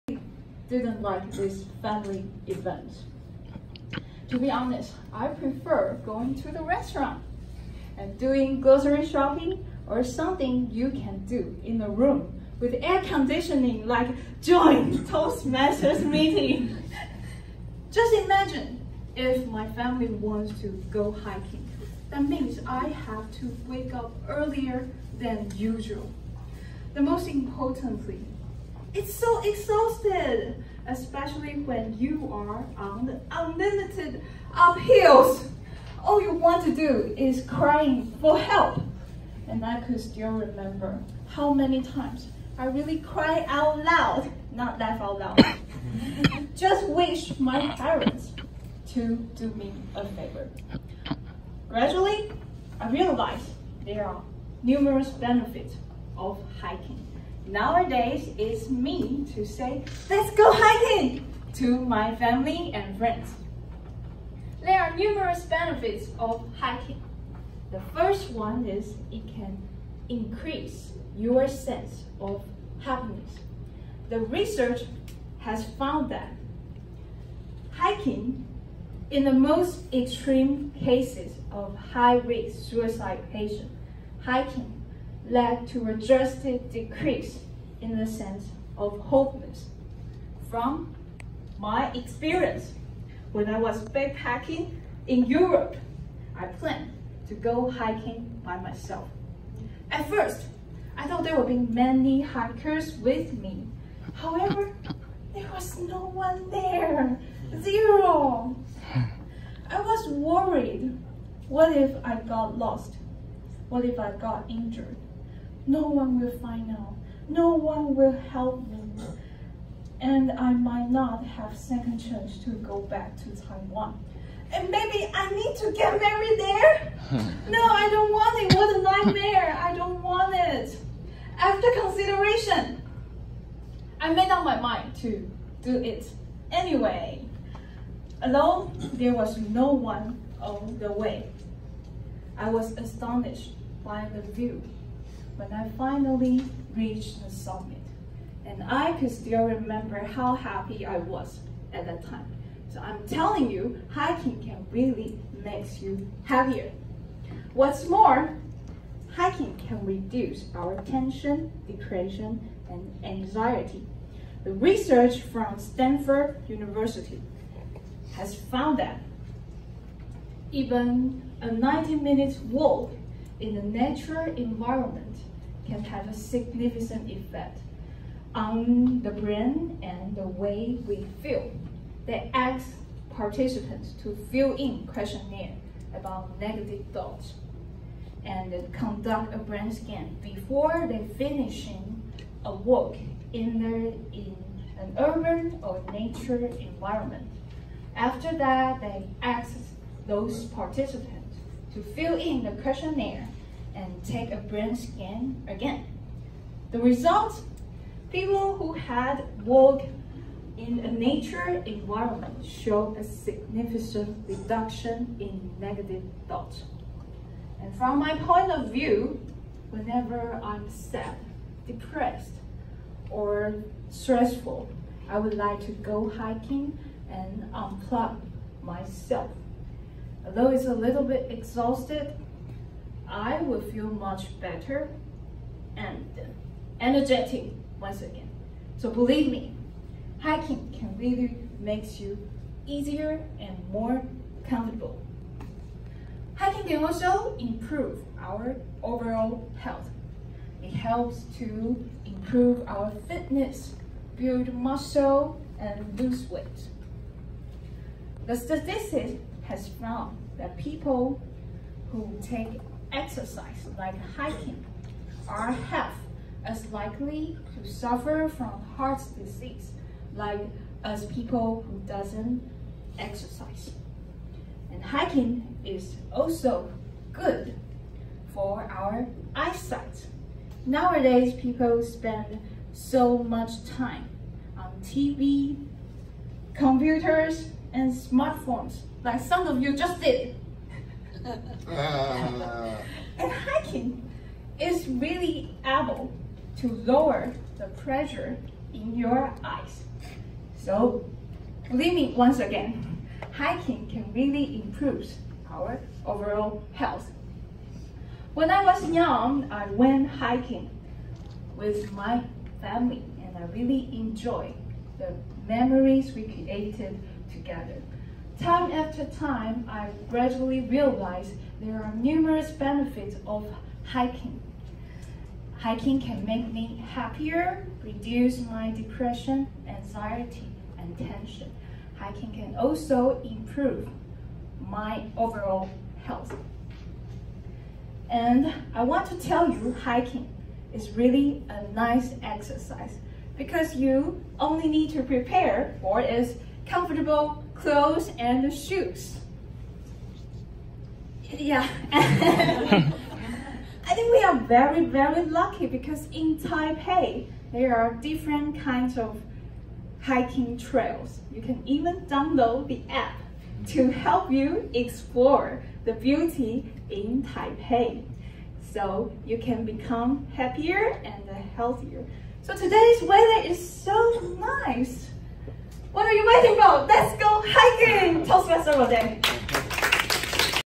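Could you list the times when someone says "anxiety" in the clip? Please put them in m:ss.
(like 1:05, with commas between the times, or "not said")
2:43, 5:29.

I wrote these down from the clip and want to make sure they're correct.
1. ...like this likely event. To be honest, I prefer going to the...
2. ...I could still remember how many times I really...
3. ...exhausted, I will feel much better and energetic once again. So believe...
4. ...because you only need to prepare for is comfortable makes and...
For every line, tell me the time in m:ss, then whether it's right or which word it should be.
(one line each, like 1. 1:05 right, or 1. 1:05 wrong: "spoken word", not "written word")
1. 0:01 wrong: "family", not "likely"
2. 0:39 right
3. 3:51 right
4. 5:43 wrong: "clothes", not "makes".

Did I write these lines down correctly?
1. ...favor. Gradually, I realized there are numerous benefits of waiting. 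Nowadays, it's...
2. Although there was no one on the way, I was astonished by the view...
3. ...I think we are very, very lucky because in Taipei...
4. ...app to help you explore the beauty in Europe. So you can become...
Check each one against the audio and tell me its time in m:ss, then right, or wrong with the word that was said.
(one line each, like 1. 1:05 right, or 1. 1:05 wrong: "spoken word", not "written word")
1. 0:50 wrong: "hiking", not "waiting"
2. 2:18 right
3. 5:51 right
4. 6:02 wrong: "Taipei", not "Europe".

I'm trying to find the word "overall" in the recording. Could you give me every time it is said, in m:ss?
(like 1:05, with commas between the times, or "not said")
4:08, 5:06, 5:35.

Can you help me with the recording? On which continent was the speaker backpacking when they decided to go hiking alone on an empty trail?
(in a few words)
Europe.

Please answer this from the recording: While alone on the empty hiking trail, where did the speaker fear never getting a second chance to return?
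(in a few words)
Taiwan.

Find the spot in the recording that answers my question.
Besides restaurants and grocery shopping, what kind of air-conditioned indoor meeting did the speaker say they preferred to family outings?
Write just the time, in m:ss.
0:15.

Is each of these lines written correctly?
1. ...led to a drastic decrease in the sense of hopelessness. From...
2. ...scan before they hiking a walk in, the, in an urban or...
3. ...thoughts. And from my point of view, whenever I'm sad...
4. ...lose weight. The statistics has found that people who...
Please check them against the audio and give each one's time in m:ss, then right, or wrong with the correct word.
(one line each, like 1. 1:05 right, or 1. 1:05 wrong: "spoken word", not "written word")
1. 1:25 right
2. 3:09 wrong: "finishing", not "hiking"
3. 3:36 right
4. 4:15 right.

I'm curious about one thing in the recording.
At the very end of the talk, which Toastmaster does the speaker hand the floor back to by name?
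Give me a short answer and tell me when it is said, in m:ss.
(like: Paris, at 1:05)
Rodan, at 6:18.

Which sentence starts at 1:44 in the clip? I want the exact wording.
However, there was no one there.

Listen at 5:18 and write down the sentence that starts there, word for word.
Time after time, I gradually realized there are numerous benefits of hiking.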